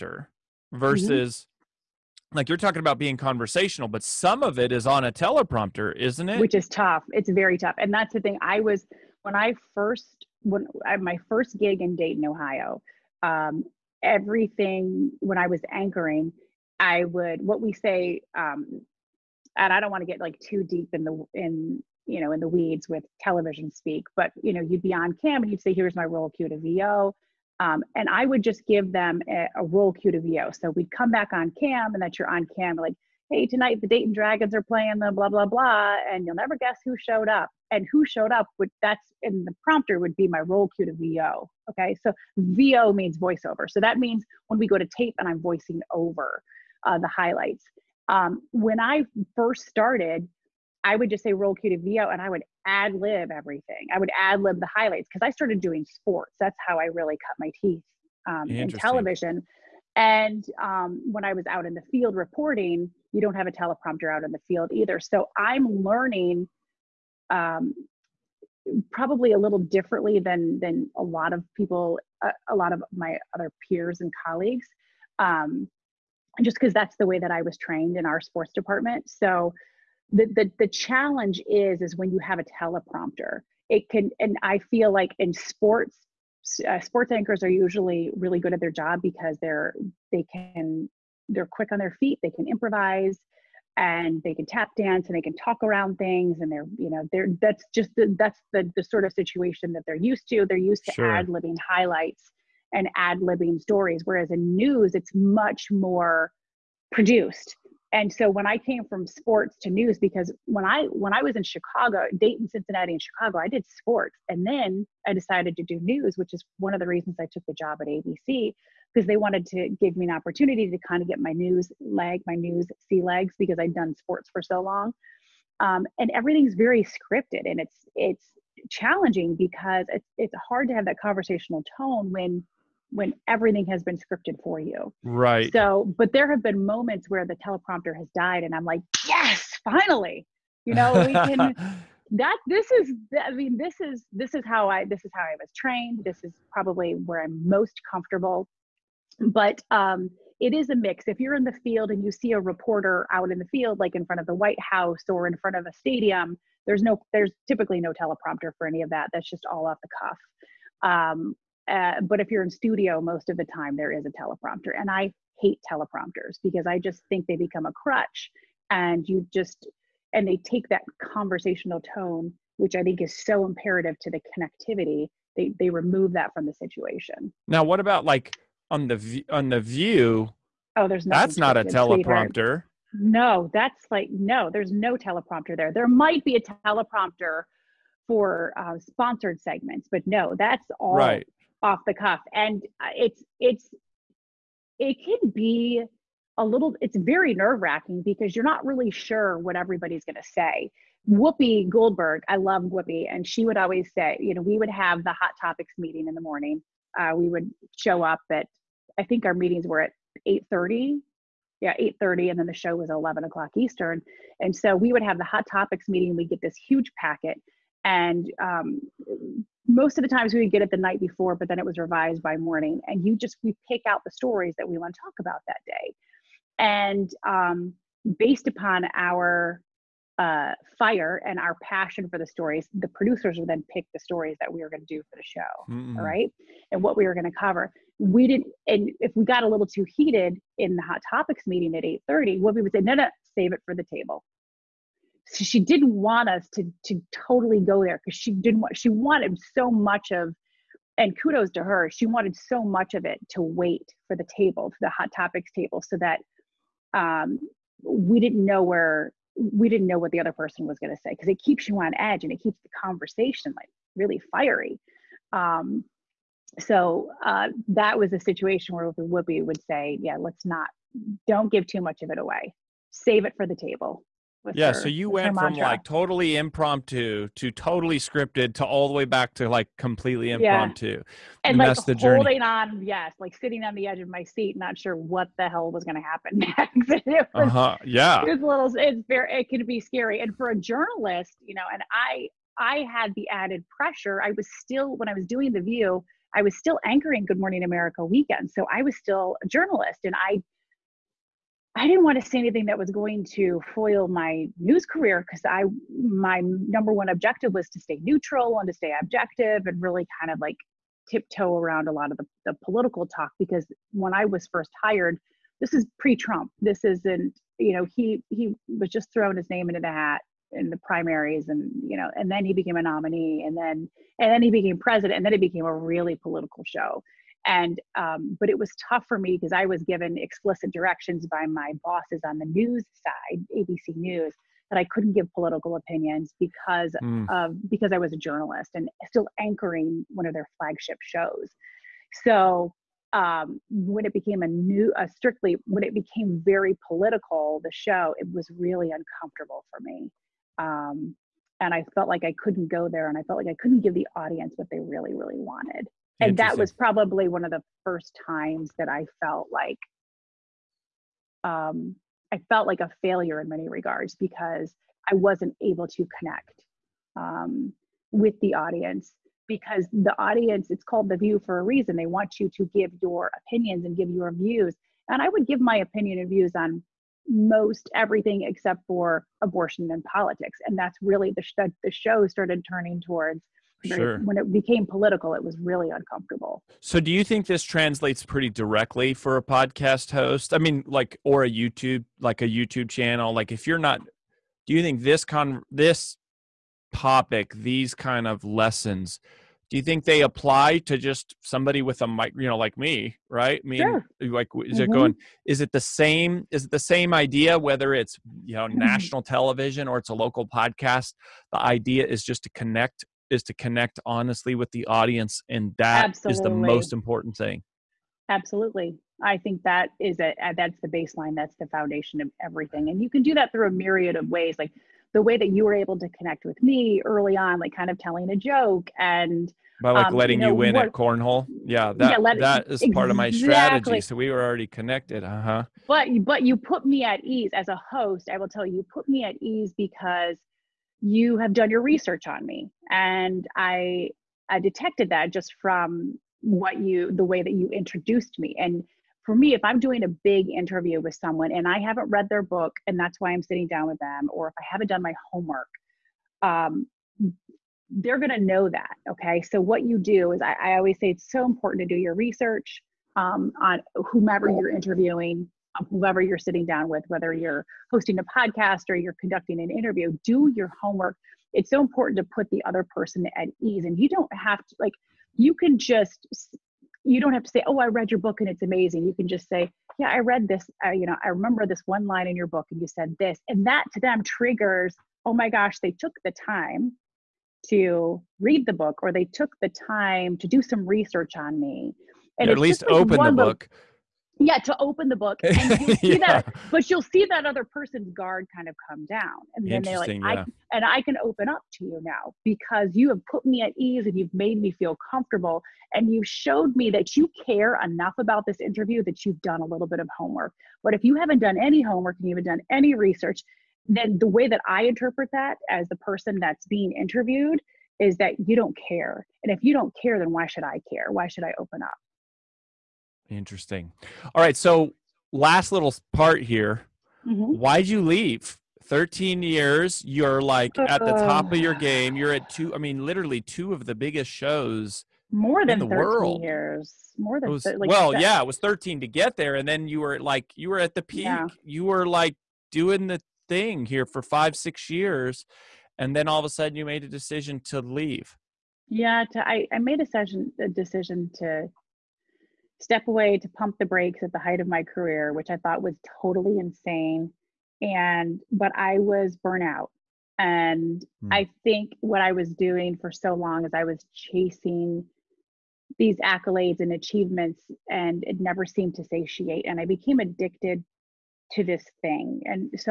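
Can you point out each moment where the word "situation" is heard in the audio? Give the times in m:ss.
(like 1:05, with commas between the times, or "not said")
1:39, 2:56, 4:28.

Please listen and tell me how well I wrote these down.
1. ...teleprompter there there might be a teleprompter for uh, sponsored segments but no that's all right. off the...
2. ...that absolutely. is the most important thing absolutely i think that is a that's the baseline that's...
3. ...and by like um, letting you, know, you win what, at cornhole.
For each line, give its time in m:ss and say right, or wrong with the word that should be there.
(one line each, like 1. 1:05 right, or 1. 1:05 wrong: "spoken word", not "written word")
1. 3:04 right
2. 6:55 right
3. 7:08 right.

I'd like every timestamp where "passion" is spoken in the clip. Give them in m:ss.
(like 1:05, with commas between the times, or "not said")
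3:51.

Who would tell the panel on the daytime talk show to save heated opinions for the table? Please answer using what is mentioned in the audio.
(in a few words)
Whoopi Goldberg.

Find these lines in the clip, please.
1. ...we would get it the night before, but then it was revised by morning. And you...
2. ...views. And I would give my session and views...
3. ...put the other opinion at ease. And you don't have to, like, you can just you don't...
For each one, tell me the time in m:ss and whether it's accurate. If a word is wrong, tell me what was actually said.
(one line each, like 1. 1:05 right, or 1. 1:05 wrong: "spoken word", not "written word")
1. 3:40 right
2. 6:14 wrong: "opinion", not "session"
3. 7:52 wrong: "person", not "opinion".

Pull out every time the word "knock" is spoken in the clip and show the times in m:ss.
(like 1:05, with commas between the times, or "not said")
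not said.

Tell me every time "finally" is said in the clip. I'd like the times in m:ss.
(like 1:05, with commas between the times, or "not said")
2:19.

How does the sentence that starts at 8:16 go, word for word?
that but you'll see that other person's guard kind of come down and then they're like yeah.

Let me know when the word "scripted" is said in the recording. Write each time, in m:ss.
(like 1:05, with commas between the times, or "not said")
2:06, 2:13, 4:37.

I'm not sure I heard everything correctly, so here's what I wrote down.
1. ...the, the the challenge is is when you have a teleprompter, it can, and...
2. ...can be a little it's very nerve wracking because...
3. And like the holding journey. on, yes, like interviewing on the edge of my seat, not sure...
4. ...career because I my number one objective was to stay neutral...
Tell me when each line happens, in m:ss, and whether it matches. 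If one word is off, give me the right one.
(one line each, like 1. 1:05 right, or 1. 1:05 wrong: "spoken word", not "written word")
1. 1:20 right
2. 3:15 right
3. 4:41 wrong: "sitting", not "interviewing"
4. 5:04 right.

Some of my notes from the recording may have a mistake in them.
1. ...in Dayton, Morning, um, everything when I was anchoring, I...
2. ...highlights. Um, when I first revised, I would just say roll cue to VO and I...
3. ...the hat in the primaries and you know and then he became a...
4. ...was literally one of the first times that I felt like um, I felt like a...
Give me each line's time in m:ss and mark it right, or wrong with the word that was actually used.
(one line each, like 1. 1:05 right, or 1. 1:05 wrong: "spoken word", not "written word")
1. 0:11 wrong: "Ohio", not "Morning"
2. 0:47 wrong: "started", not "revised"
3. 5:19 right
4. 5:56 wrong: "probably", not "literally".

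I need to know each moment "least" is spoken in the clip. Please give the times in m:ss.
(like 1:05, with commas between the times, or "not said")
8:12.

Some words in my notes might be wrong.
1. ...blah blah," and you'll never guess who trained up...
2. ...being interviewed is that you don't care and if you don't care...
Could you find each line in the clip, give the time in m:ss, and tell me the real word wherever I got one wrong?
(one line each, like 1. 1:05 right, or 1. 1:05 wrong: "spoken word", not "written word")
1. 0:35 wrong: "showed", not "trained"
2. 8:36 right.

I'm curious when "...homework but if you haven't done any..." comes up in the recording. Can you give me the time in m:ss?
8:30.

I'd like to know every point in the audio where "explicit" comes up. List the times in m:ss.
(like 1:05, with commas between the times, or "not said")
5:30.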